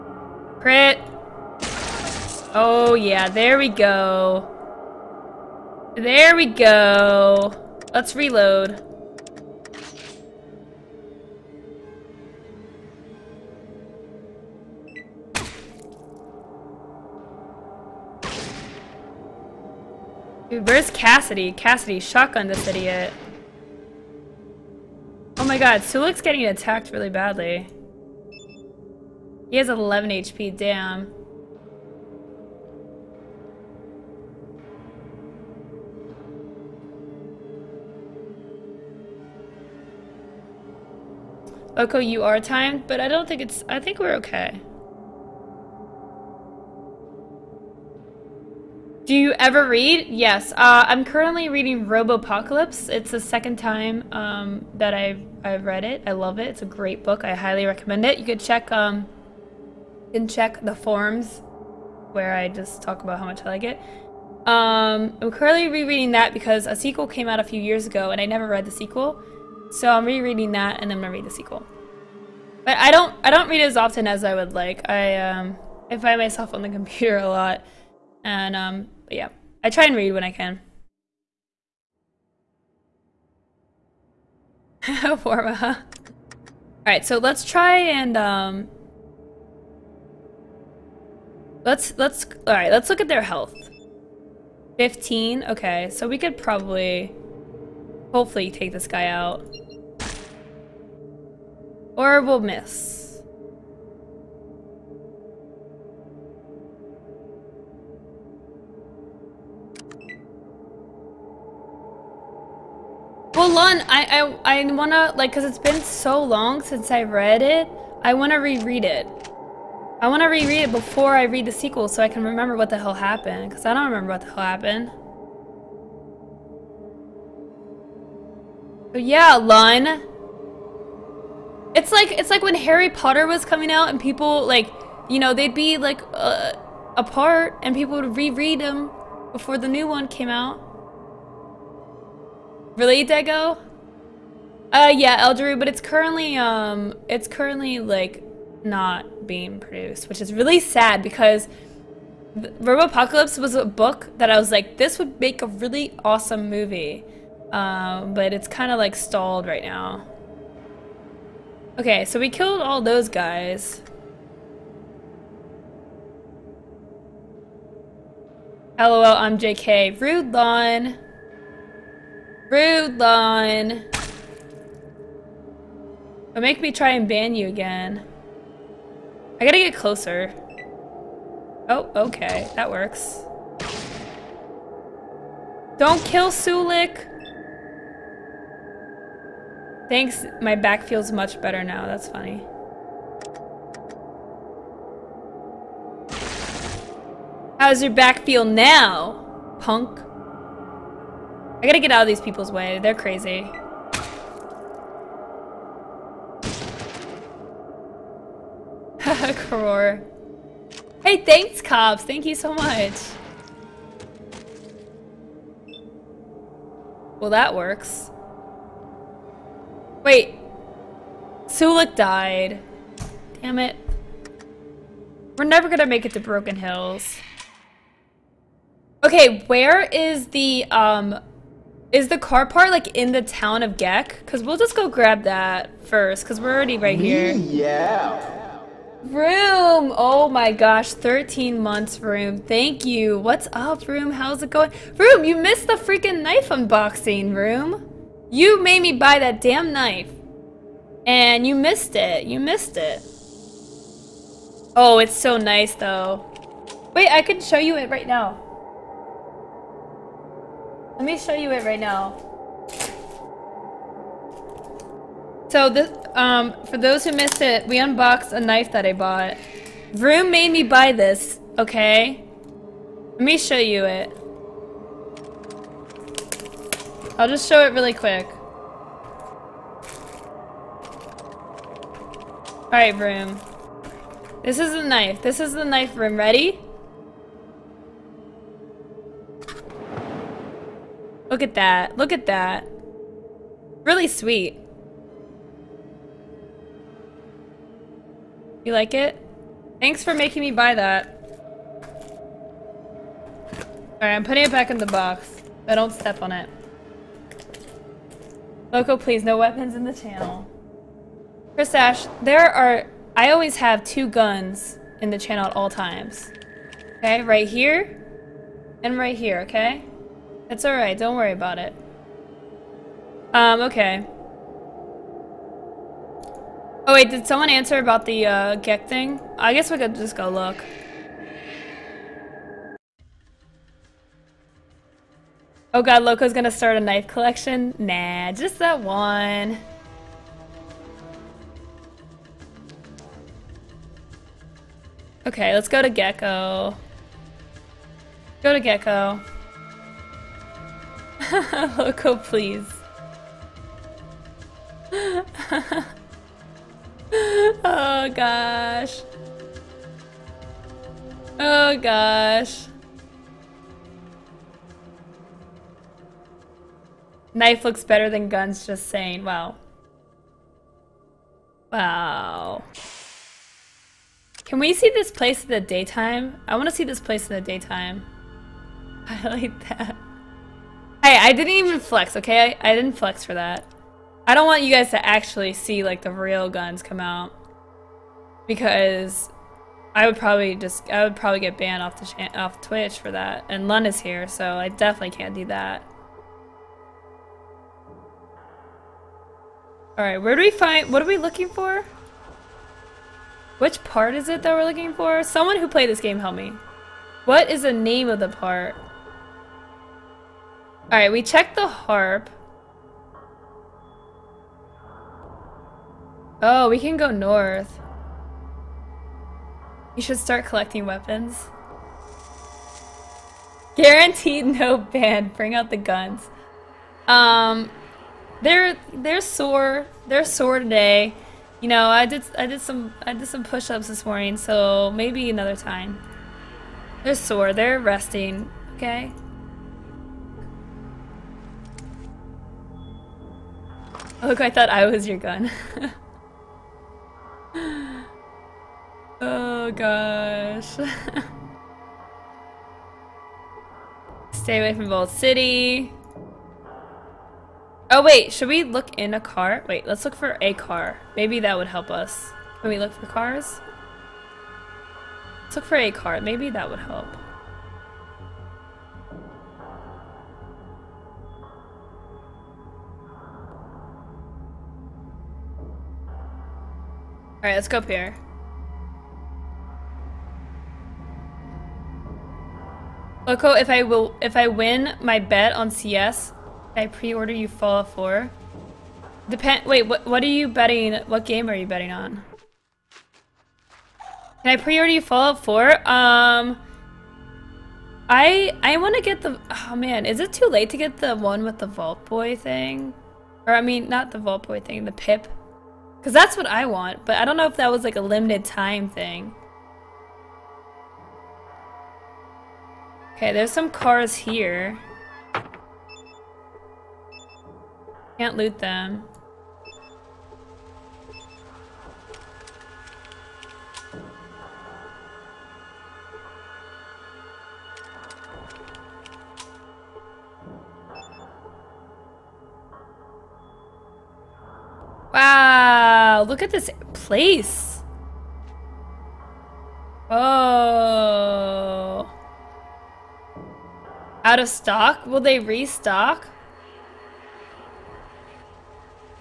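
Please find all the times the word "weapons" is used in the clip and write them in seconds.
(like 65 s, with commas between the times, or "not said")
309 s, 420 s.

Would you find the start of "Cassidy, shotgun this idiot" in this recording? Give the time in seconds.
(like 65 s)
21 s.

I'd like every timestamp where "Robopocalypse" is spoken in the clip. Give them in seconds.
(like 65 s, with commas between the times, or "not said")
51 s, 152 s.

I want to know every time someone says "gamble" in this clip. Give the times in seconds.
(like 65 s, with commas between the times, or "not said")
not said.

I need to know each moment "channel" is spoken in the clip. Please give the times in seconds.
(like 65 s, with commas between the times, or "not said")
309 s, 315 s.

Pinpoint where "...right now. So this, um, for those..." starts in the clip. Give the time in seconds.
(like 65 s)
261 s.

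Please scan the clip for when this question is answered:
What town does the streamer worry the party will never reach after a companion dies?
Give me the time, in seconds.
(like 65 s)
226 s.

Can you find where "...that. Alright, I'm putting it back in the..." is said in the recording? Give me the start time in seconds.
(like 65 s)
300 s.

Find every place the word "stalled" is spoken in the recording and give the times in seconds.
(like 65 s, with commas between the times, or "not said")
158 s.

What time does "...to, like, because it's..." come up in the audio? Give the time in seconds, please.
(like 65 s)
114 s.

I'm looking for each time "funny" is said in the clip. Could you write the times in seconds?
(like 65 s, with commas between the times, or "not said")
192 s.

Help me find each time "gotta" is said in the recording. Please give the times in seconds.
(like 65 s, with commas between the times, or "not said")
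179 s, 201 s.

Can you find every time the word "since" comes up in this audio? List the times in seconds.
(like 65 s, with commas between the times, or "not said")
116 s.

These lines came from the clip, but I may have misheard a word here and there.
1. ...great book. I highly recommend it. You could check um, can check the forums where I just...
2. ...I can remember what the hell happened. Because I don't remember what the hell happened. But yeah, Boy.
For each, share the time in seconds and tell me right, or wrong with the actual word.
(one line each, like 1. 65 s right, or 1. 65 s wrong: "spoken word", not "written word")
1. 56 s right
2. 122 s wrong: "Lun", not "Boy".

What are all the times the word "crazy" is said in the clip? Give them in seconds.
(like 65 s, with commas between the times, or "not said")
202 s.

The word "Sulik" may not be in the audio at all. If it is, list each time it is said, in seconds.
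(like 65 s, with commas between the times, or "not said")
25 s, 186 s, 221 s.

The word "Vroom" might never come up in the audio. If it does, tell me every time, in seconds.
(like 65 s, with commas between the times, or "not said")
269 s, 282 s.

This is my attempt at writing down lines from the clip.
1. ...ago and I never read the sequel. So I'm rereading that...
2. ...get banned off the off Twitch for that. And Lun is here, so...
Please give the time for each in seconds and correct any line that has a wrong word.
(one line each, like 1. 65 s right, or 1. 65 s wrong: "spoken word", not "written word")
1. 67 s right
2. 391 s right.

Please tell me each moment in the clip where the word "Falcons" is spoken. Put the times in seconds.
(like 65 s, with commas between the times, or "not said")
not said.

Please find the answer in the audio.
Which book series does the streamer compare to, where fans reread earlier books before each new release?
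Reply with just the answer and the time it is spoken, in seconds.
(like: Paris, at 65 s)
Harry Potter, at 132 s.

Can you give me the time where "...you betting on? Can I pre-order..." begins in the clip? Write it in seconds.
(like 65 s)
491 s.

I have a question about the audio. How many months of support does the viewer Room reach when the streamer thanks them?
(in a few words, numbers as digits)
13.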